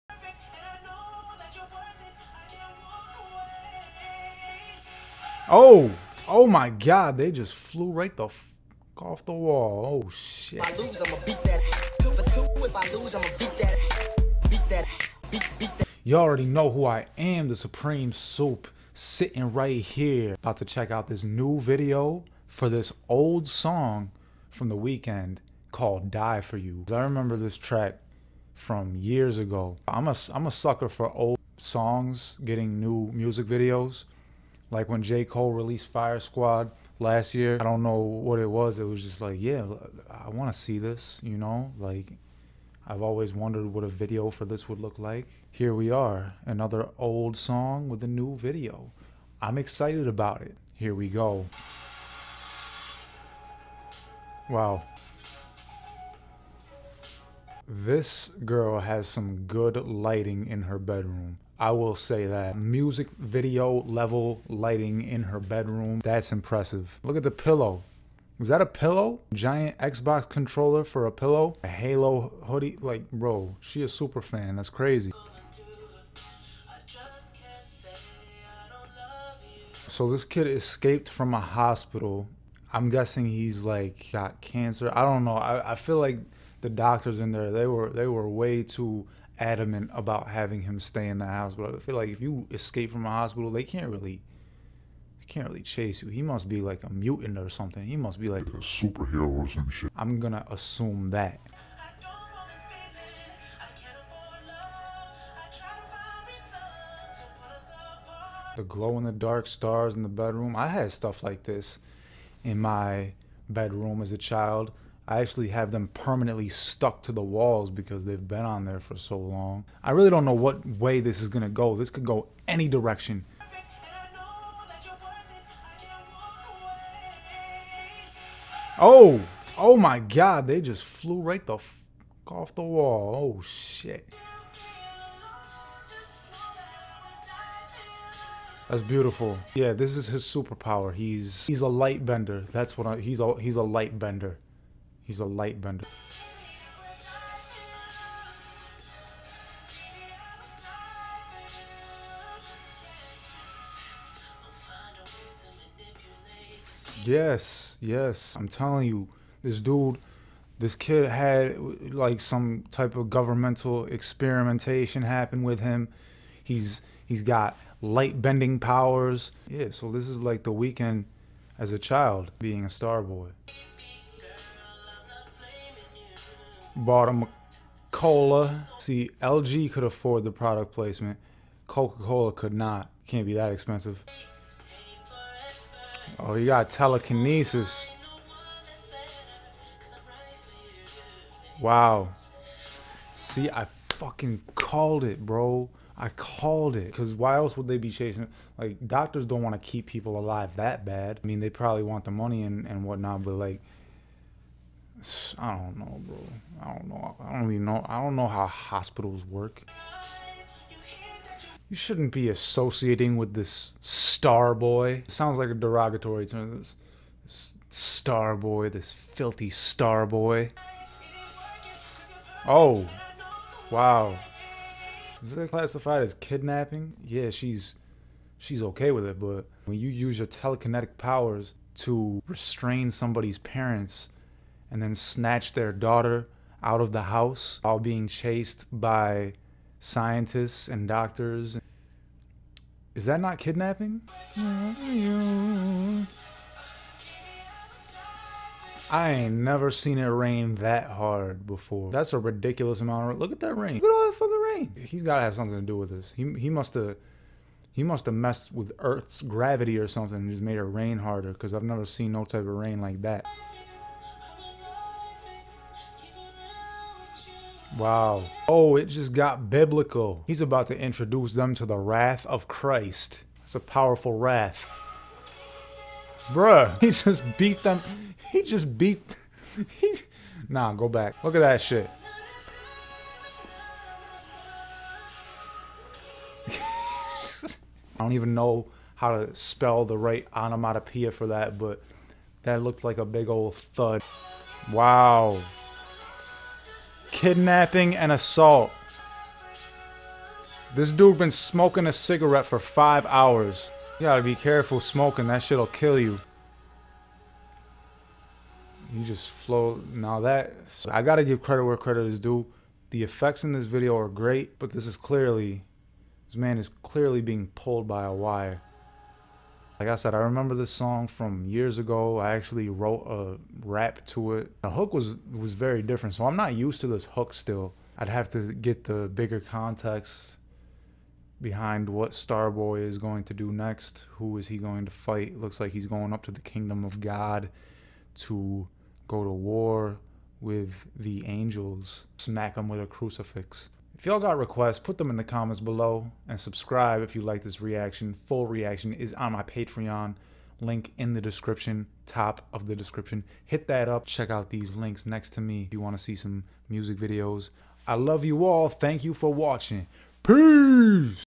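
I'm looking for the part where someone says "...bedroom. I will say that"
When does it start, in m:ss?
1:00.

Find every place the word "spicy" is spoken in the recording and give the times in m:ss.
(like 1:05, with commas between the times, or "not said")
not said.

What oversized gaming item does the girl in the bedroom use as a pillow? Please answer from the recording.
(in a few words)
Xbox controller.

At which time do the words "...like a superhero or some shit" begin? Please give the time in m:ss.
1:38.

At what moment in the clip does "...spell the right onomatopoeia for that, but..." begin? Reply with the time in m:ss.
4:49.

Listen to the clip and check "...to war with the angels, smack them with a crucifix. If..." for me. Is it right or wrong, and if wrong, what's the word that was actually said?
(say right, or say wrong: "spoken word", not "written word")
right.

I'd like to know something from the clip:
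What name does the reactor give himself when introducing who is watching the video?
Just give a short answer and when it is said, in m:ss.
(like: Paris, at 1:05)
The Supreme Soup, at 0:17.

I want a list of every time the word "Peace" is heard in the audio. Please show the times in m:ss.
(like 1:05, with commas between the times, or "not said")
6:00.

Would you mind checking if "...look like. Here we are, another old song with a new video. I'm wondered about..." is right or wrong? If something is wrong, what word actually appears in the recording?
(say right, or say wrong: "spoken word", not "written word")
wrong: "excited", not "wondered".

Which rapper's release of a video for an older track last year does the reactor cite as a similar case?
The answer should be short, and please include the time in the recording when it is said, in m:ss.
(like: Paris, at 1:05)
J. Cole, at 0:35.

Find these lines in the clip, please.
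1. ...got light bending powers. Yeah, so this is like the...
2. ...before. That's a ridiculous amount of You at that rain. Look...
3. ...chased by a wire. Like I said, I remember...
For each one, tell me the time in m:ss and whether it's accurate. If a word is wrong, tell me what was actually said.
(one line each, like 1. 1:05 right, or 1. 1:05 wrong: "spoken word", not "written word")
1. 2:47 right
2. 4:11 wrong: "Look", not "You"
3. 5:17 wrong: "pulled", not "chased".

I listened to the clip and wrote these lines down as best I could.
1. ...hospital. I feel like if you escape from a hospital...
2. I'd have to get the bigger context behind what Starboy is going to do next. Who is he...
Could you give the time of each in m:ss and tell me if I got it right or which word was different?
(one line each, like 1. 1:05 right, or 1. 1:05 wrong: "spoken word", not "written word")
1. 1:31 right
2. 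5:27 right.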